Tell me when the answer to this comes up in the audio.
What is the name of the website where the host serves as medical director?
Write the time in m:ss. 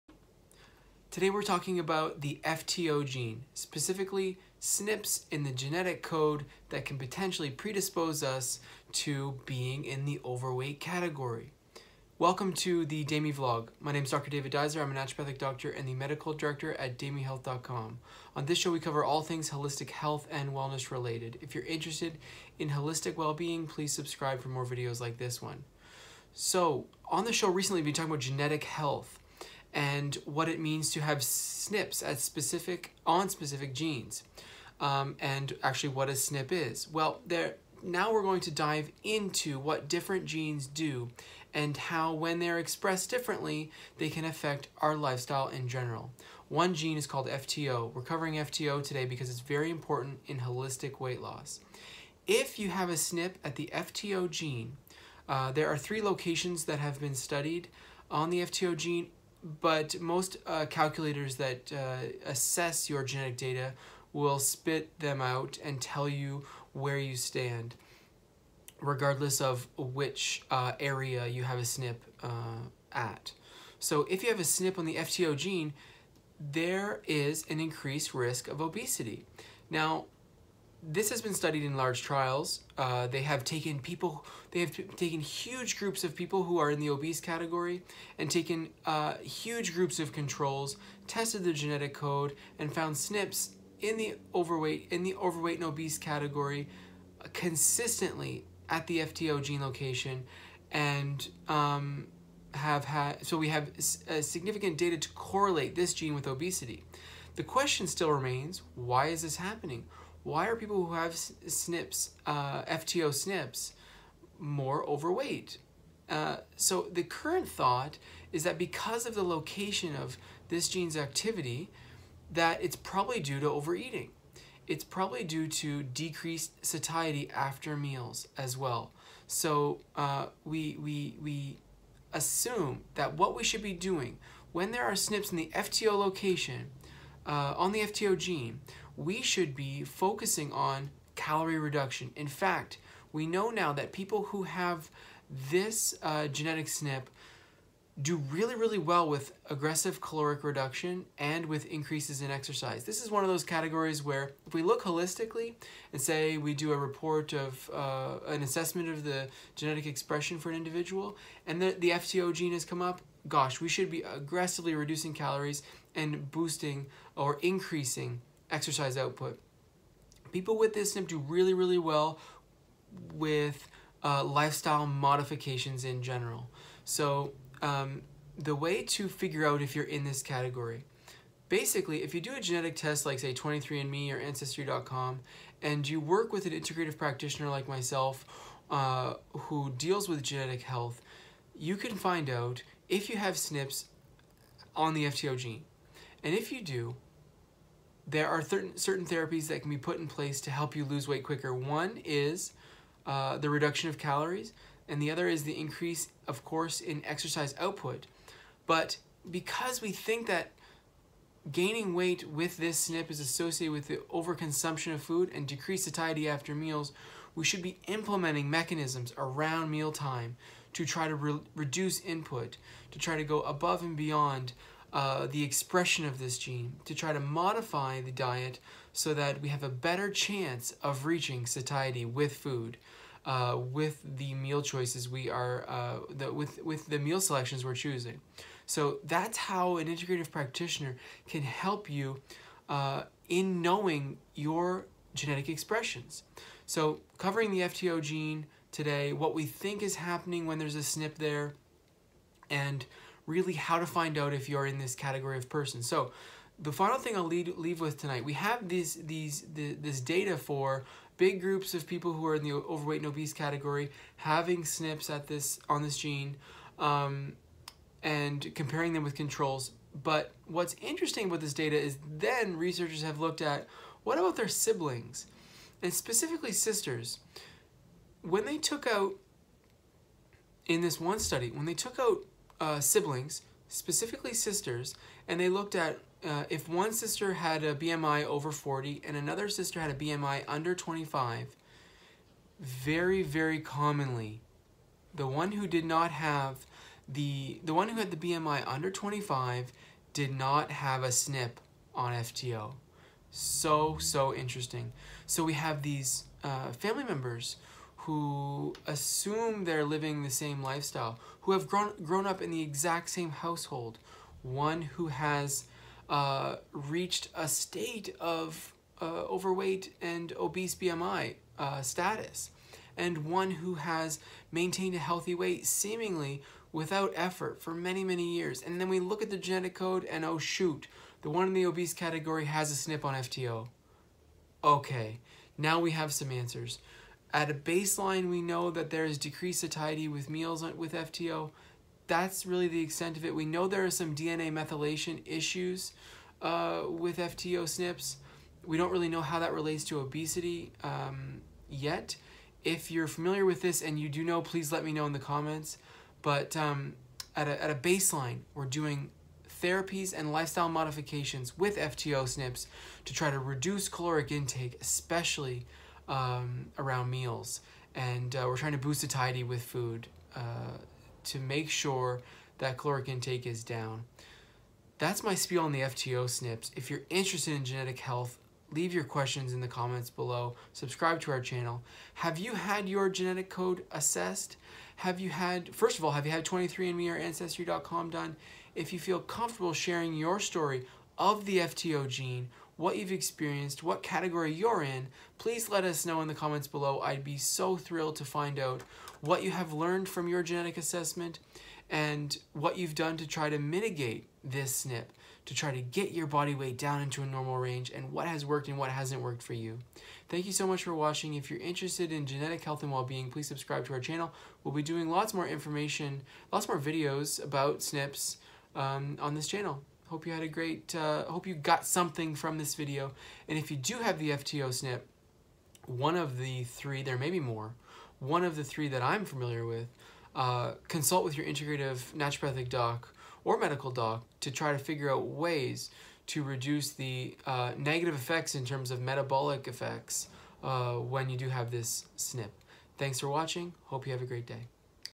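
0:16.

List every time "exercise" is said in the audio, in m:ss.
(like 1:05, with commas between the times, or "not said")
2:32, 2:48, 3:27.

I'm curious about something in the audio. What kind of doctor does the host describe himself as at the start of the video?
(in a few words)
naturopathic doctor.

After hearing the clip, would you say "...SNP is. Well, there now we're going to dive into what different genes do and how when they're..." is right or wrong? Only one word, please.
right.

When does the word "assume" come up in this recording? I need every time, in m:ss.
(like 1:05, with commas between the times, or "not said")
2:12, 5:08.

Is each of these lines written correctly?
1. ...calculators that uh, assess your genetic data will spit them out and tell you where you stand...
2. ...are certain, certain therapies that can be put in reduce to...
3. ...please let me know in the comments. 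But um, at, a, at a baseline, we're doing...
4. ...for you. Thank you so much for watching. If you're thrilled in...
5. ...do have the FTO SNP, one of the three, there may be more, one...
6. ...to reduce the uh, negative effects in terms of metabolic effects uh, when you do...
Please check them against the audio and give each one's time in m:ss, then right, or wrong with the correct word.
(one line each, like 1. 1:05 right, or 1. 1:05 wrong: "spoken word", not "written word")
1. 1:00 right
2. 3:18 wrong: "place", not "reduce"
3. 5:54 right
4. 6:49 wrong: "interested", not "thrilled"
5. 7:03 right
6. 7:16 right.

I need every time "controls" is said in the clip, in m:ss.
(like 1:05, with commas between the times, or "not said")
1:30, 4:29.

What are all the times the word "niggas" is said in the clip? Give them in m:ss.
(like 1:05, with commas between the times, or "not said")
not said.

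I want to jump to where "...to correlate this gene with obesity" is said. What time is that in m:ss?
1:44.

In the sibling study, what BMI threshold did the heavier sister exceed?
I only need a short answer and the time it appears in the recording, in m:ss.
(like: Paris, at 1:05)
40, at 4:48.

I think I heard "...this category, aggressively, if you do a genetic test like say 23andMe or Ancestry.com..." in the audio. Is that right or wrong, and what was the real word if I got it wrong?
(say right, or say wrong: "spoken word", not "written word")
wrong: "basically", not "aggressively".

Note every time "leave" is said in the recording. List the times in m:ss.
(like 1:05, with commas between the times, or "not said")
4:17, 6:18.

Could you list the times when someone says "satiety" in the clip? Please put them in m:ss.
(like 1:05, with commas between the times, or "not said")
2:06, 3:35, 3:51, 5:39, 6:09.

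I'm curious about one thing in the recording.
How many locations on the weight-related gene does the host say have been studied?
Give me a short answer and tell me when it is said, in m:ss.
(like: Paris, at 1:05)
3, at 0:55.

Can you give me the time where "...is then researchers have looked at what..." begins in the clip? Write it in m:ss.
4:31.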